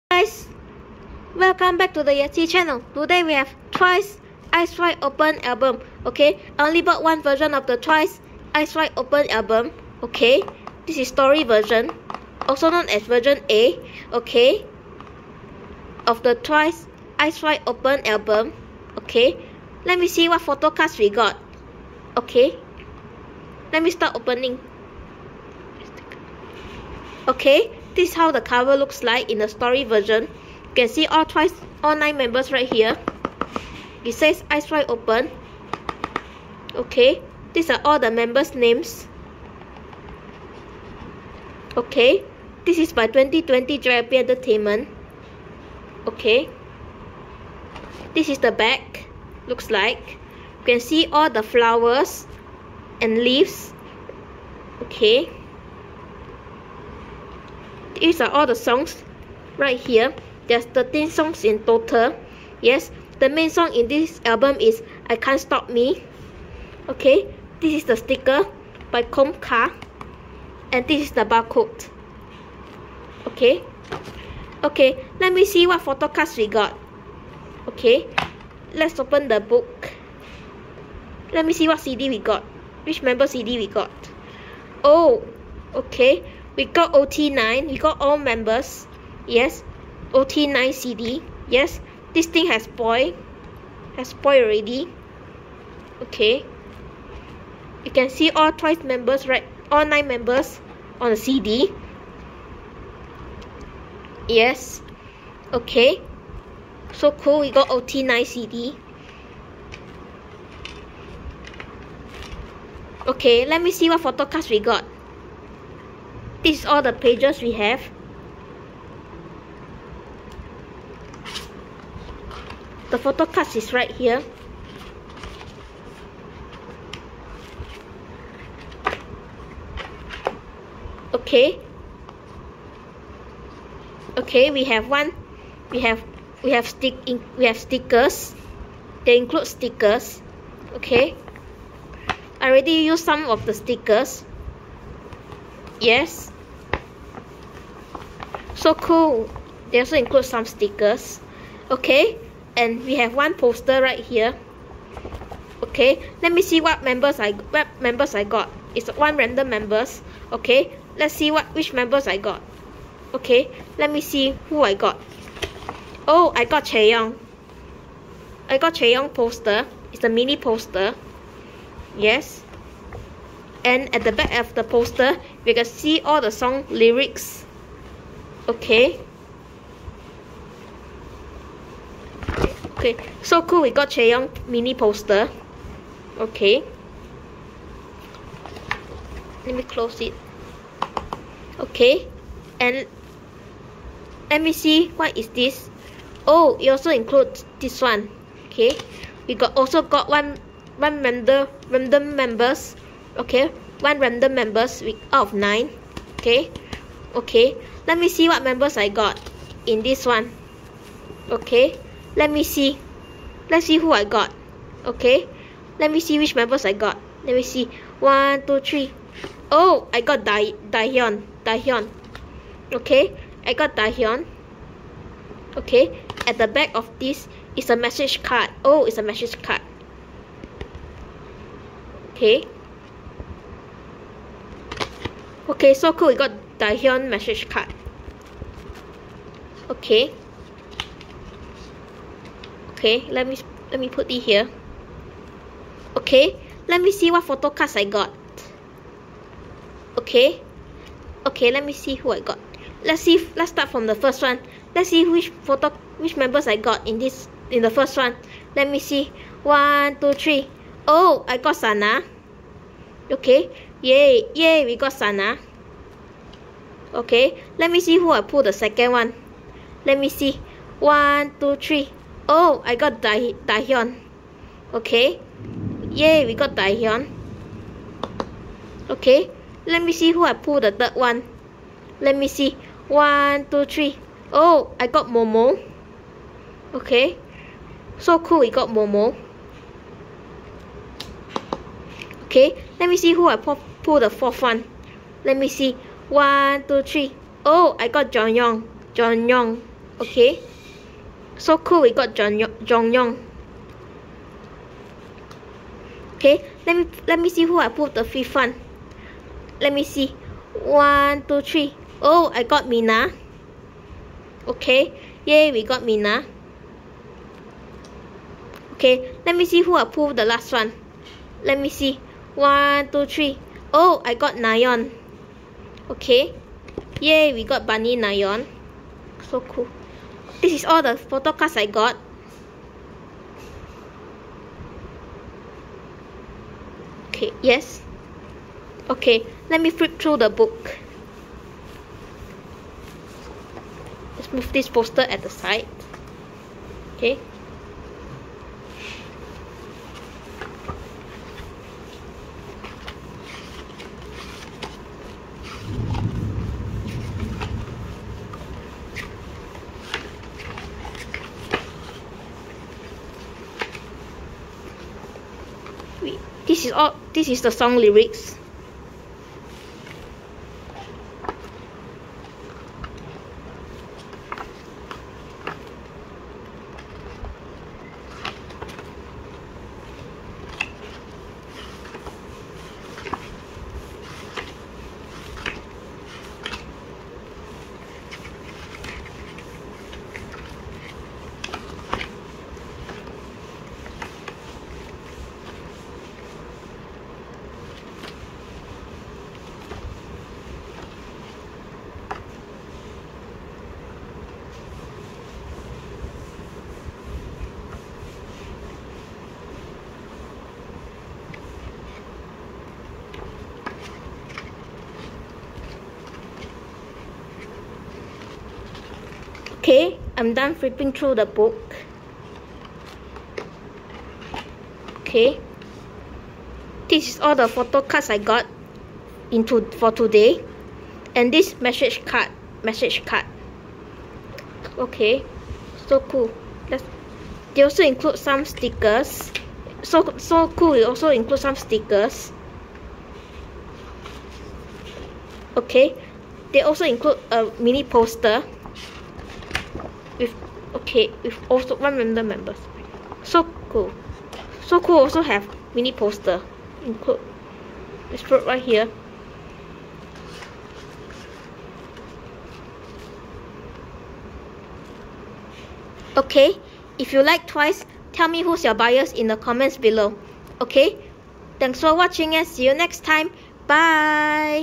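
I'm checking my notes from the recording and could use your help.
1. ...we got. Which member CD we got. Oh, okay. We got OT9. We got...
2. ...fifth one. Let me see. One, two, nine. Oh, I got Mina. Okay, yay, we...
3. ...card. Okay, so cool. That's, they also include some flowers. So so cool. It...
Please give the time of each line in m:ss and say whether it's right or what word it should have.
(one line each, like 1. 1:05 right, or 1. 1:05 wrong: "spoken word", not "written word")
1. 1:22 right
2. 5:08 wrong: "three", not "nine"
3. 7:13 wrong: "stickers", not "flowers".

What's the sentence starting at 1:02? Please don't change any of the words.
Yes, the main song in this album is I Can't Stop Me.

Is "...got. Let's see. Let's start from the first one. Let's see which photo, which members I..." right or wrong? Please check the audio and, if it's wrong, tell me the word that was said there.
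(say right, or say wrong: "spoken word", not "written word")
right.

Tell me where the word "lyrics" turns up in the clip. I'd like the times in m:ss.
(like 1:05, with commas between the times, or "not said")
2:56, 6:07.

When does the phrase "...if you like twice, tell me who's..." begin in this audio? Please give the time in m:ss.
7:46.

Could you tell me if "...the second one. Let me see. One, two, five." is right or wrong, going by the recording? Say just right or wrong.
wrong.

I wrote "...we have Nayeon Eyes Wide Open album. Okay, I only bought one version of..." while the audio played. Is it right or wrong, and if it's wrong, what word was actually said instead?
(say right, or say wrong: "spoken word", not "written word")
wrong: "Twice", not "Nayeon".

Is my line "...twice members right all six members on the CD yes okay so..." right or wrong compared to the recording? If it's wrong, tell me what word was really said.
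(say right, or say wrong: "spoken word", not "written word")
wrong: "nine", not "six".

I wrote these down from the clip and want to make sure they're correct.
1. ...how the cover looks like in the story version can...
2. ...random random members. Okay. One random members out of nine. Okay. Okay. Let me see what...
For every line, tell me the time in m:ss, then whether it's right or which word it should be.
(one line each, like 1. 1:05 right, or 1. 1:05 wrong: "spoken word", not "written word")
1. 0:28 right
2. 3:21 right.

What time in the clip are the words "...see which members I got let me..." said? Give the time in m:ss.
3:35.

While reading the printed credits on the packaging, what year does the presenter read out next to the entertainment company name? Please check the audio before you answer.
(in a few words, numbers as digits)
2020.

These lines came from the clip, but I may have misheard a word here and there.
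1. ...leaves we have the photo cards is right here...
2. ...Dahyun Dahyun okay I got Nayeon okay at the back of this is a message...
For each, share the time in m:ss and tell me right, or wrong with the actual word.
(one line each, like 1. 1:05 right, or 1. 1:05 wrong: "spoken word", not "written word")
1. 1:56 wrong: "pages", not "leaves"
2. 3:40 wrong: "Dahyun", not "Nayeon".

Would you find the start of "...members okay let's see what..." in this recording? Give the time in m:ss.
2:39.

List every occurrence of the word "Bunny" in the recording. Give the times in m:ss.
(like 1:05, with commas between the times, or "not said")
5:27.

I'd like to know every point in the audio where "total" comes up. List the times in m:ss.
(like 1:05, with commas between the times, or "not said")
1:01.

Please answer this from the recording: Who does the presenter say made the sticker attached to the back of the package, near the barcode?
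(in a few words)
Comca.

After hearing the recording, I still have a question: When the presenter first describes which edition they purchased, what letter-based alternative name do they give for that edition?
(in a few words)
version A.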